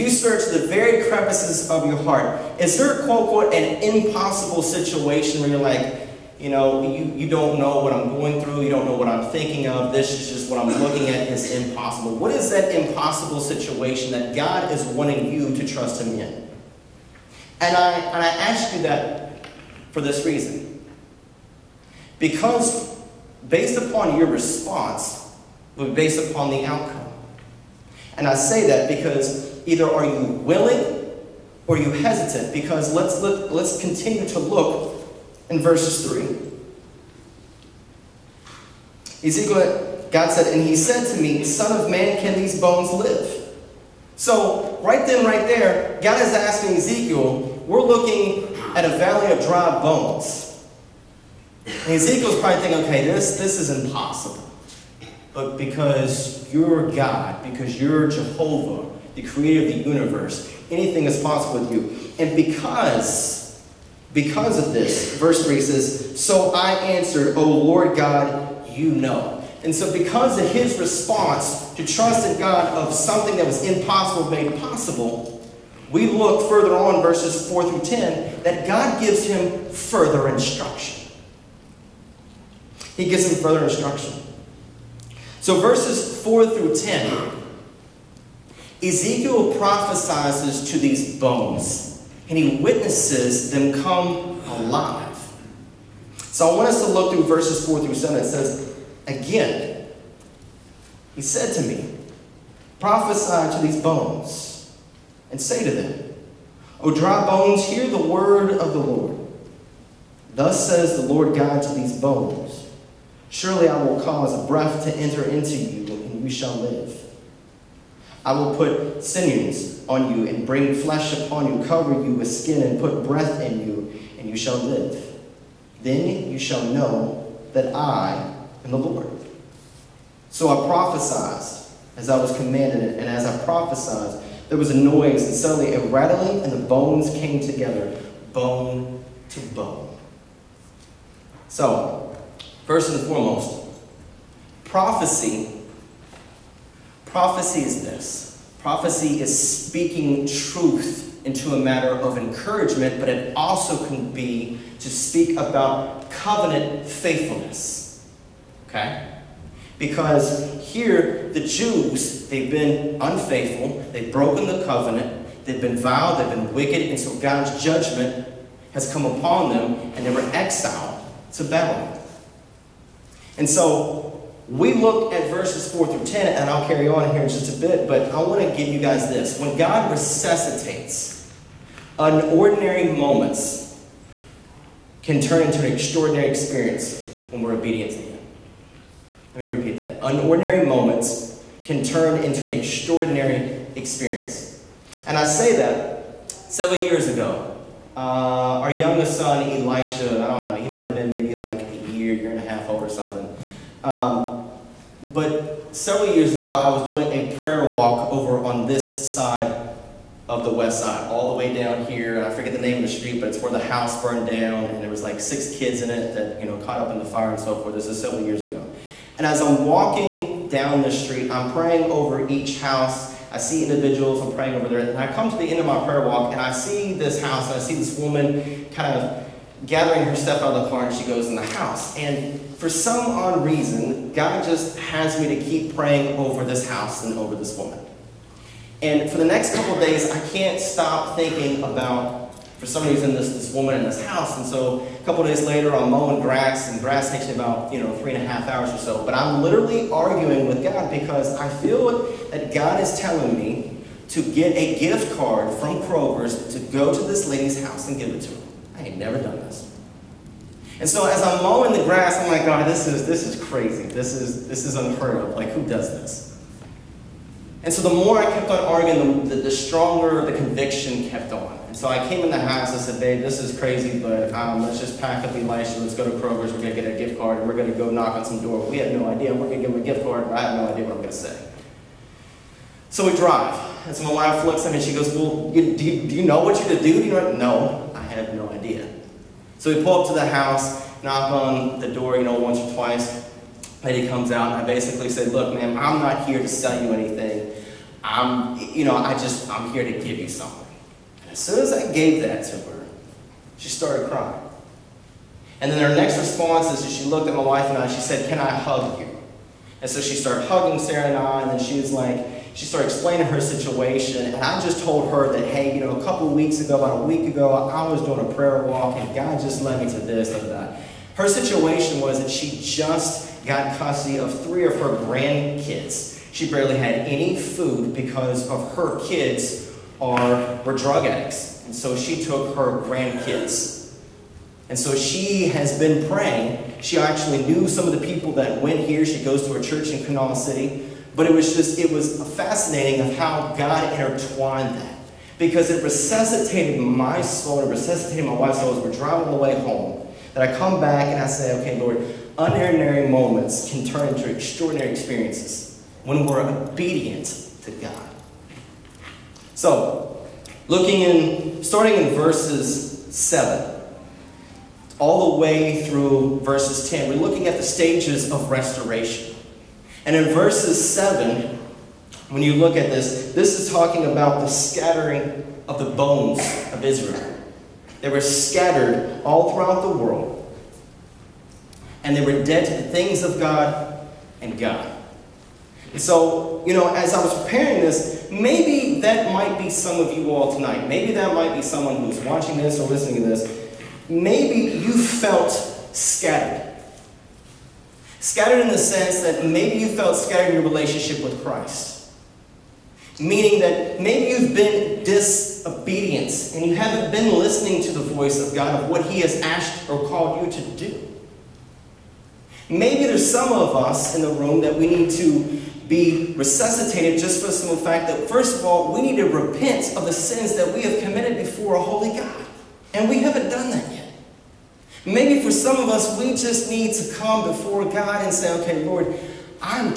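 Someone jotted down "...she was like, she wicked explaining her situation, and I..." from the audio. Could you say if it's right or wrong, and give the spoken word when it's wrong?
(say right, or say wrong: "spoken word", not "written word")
wrong: "started", not "wicked".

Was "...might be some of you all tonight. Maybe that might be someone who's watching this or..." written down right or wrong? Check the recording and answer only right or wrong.
right.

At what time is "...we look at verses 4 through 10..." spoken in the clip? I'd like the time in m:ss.
2:54.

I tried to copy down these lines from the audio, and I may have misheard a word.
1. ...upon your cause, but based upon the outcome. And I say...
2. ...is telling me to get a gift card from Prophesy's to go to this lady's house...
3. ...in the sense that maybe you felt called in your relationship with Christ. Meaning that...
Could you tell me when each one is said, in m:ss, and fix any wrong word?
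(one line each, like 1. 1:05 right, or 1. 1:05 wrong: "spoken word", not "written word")
1. 0:23 wrong: "response", not "cause"
2. 4:12 wrong: "Kroger", not "Prophesy"
3. 6:38 wrong: "scattered", not "called".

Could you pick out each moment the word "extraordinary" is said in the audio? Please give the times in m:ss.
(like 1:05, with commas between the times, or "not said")
3:05, 3:12, 5:54.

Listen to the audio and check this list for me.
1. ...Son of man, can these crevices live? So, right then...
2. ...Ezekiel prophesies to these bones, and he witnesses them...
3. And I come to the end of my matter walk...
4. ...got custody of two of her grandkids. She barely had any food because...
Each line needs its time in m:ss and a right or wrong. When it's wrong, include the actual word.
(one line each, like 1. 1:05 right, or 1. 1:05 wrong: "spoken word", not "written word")
1. 0:41 wrong: "bones", not "crevices"
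2. 1:28 right
3. 3:44 wrong: "prayer", not "matter"
4. 5:23 wrong: "three", not "two".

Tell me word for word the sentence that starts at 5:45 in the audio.
Because it resuscitated my soul, and it resuscitated my wife's soul as we're driving on the way home.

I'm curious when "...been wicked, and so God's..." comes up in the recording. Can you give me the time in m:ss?
2:46.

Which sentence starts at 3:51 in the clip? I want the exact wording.
And for some odd reason, God just has me to keep praying over this house and over this woman.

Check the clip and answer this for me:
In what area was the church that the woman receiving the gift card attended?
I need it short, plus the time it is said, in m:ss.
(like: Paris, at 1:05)
Kanawha City, at 5:40.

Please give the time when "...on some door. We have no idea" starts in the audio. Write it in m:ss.
4:38.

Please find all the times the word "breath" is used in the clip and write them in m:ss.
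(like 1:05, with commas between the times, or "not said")
1:54, 2:03.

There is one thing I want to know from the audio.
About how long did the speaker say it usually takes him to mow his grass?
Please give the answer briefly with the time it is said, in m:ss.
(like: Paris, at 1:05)
3.5 hours, at 4:07.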